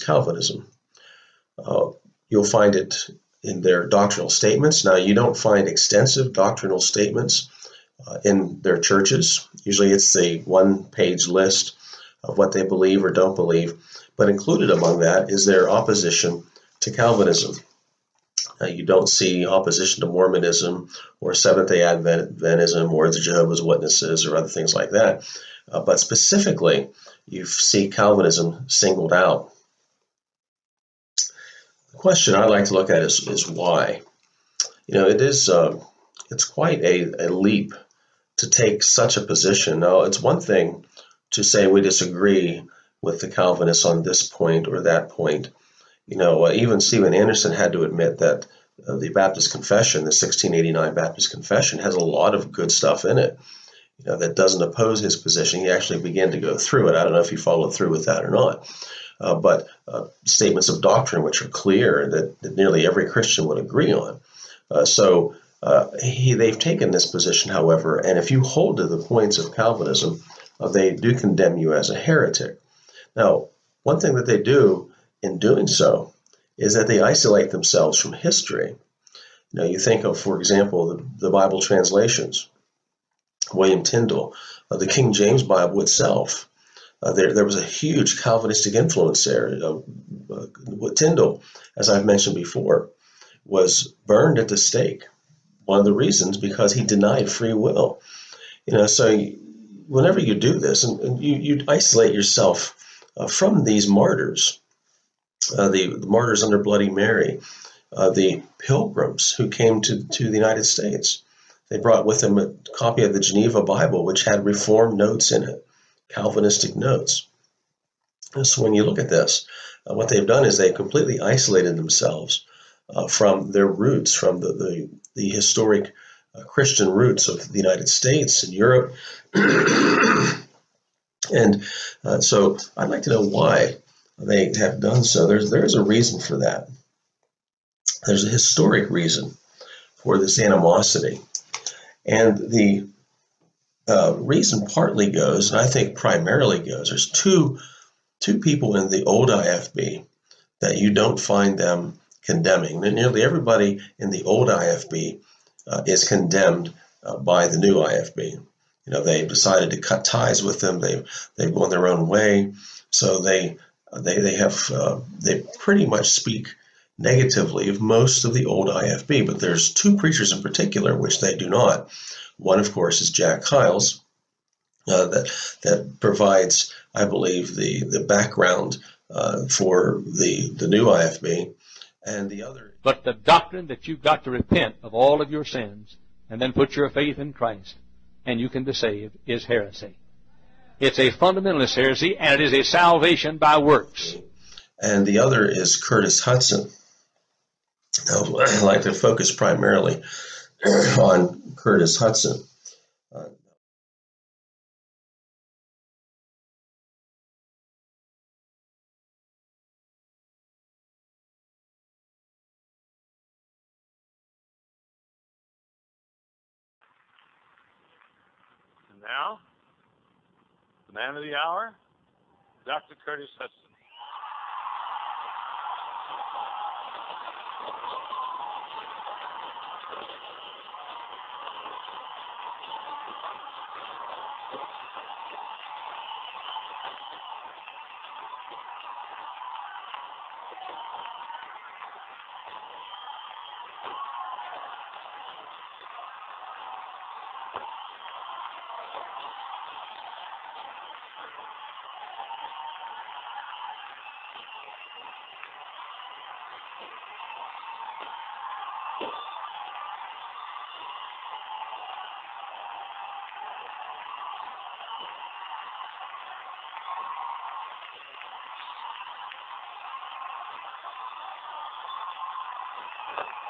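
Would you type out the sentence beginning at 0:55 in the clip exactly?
He actually began to go through it.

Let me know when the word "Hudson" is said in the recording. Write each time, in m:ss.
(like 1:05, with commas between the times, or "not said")
3:16, 3:21.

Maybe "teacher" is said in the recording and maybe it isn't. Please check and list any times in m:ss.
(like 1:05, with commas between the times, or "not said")
not said.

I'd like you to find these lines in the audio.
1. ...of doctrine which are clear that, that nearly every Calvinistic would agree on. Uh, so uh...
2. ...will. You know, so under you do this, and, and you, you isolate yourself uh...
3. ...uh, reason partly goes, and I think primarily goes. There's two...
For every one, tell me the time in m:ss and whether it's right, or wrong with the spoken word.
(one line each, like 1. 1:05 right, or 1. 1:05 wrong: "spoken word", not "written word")
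1. 1:00 wrong: "Christian", not "Calvinistic"
2. 1:37 wrong: "whenever", not "under"
3. 2:23 right.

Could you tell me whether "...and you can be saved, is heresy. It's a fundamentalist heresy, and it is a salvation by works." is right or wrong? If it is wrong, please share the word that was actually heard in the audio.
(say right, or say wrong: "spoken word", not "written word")
right.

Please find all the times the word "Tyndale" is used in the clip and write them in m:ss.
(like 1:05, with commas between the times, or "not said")
1:23, 1:30.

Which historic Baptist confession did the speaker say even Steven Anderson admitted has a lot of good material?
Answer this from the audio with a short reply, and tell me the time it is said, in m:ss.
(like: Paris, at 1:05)
1689 Baptist Confession, at 0:50.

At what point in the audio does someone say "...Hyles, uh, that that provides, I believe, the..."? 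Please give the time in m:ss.
2:53.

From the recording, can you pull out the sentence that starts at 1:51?
They brought with them a copy of the Geneva Bible, which had Reformed notes in it, Calvinistic notes.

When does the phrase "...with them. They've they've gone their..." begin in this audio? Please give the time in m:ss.
2:40.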